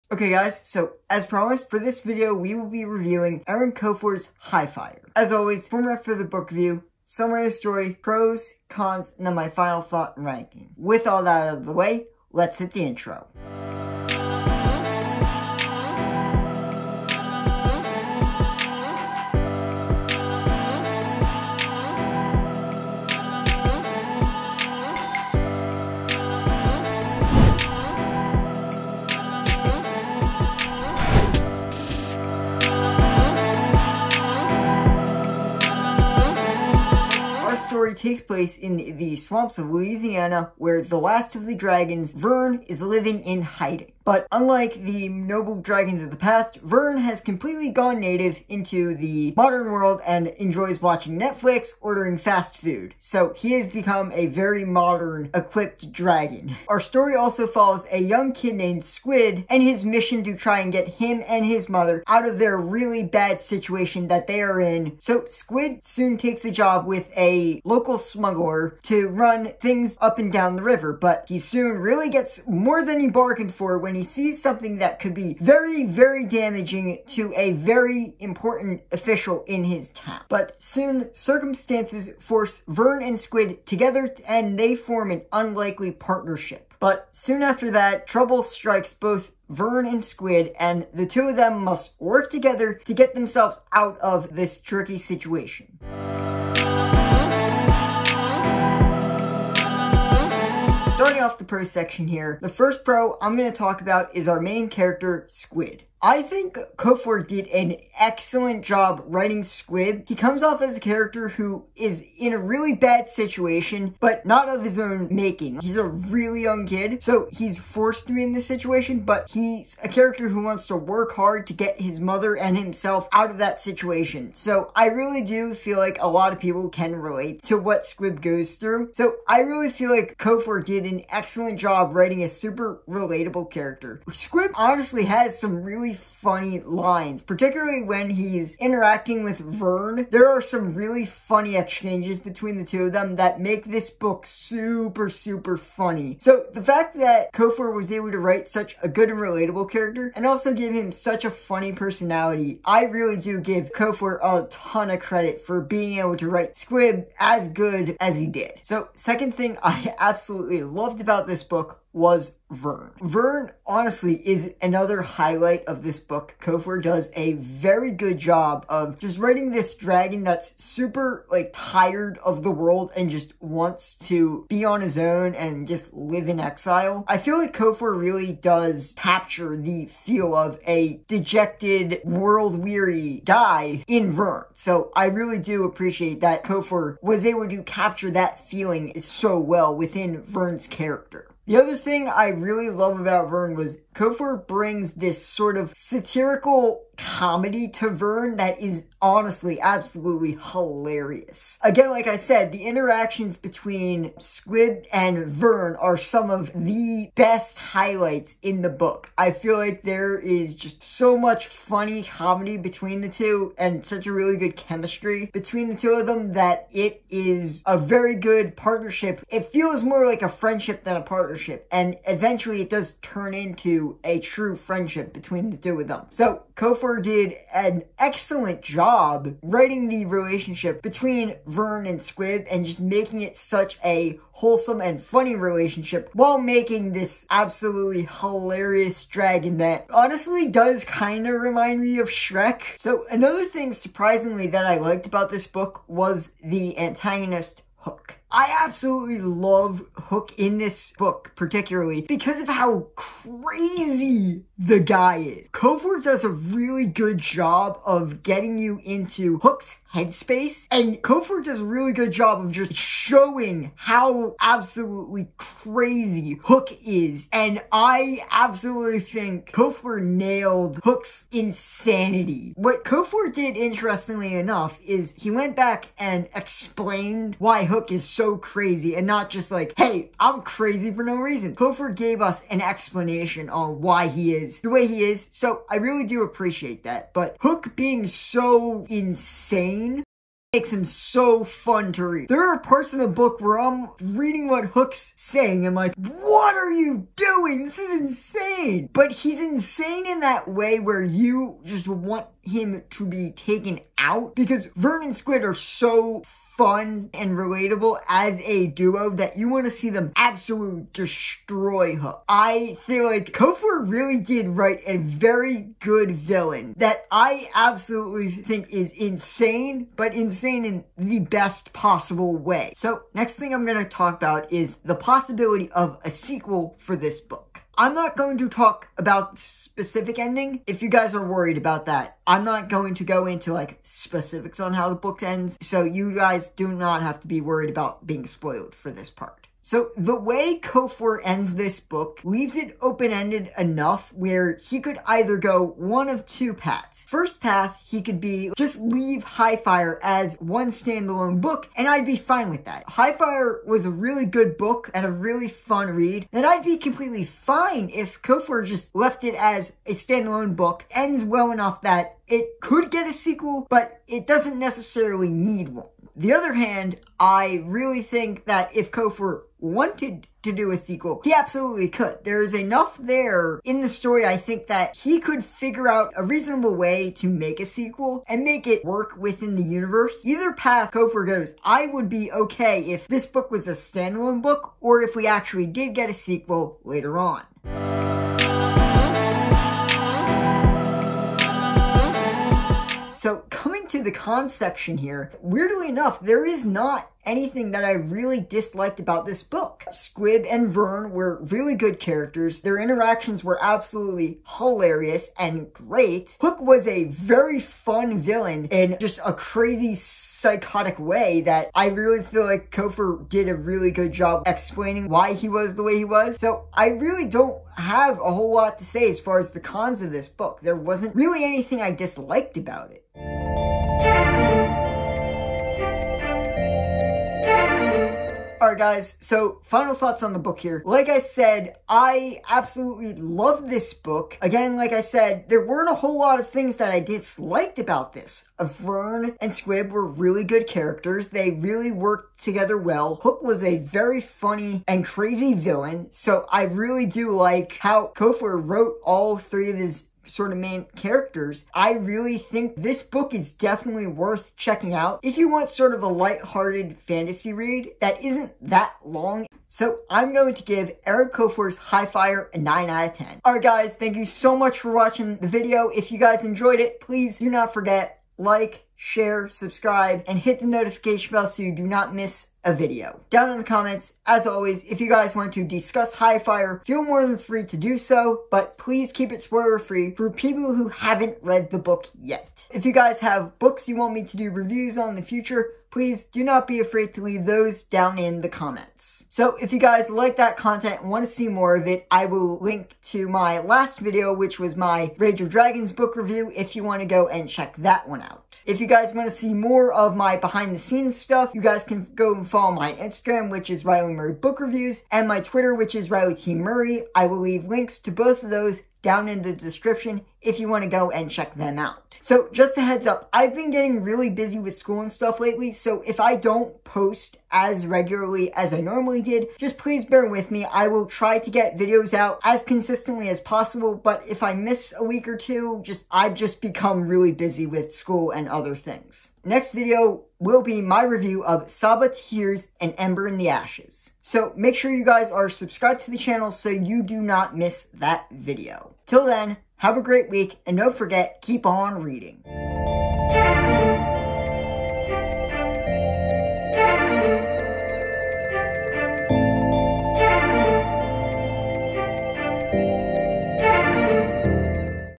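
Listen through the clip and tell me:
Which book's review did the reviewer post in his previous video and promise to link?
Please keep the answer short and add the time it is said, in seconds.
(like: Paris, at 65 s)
Rage of Dragons, at 495 s.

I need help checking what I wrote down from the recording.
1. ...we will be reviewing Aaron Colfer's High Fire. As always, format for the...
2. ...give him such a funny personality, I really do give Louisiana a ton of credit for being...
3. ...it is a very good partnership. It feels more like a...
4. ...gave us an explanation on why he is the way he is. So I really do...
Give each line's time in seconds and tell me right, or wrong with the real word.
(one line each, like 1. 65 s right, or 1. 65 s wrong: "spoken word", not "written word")
1. 2 s right
2. 150 s wrong: "Colfer", not "Louisiana"
3. 216 s right
4. 281 s right.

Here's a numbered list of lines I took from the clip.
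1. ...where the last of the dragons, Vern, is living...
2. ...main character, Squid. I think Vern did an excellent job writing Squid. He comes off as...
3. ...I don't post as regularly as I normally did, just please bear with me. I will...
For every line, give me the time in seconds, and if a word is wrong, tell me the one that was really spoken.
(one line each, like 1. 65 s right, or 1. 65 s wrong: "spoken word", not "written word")
1. 40 s right
2. 104 s wrong: "Colfer", not "Vern"
3. 516 s right.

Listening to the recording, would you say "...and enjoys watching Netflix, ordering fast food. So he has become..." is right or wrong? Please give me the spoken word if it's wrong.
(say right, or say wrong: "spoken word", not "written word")
right.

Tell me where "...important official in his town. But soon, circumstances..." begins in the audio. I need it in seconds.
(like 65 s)
78 s.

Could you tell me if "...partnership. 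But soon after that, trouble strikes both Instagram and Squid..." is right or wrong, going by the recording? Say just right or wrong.
wrong.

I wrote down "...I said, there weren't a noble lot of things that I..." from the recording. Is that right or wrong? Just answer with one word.
wrong.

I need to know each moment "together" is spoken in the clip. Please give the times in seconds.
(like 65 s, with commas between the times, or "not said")
83 s, 92 s, 442 s.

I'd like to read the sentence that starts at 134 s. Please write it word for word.
Squid honestly has some really funny lines, particularly when he's interacting with Vern.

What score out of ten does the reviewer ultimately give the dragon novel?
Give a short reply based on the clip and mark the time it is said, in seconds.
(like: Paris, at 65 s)
9, at 462 s.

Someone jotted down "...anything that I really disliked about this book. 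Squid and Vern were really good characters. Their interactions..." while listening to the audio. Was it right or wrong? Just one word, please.
right.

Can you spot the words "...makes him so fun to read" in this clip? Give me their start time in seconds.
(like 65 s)
290 s.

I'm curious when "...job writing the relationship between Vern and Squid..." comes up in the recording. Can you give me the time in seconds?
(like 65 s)
228 s.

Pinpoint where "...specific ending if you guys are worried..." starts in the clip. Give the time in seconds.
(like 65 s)
329 s.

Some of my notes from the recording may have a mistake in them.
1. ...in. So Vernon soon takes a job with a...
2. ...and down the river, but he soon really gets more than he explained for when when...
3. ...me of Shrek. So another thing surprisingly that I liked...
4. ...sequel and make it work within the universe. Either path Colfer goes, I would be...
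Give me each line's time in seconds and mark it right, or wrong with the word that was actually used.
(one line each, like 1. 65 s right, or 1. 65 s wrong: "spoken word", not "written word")
1. 64 s wrong: "Squid", not "Vernon"
2. 70 s wrong: "bargained", not "explained"
3. 241 s right
4. 377 s right.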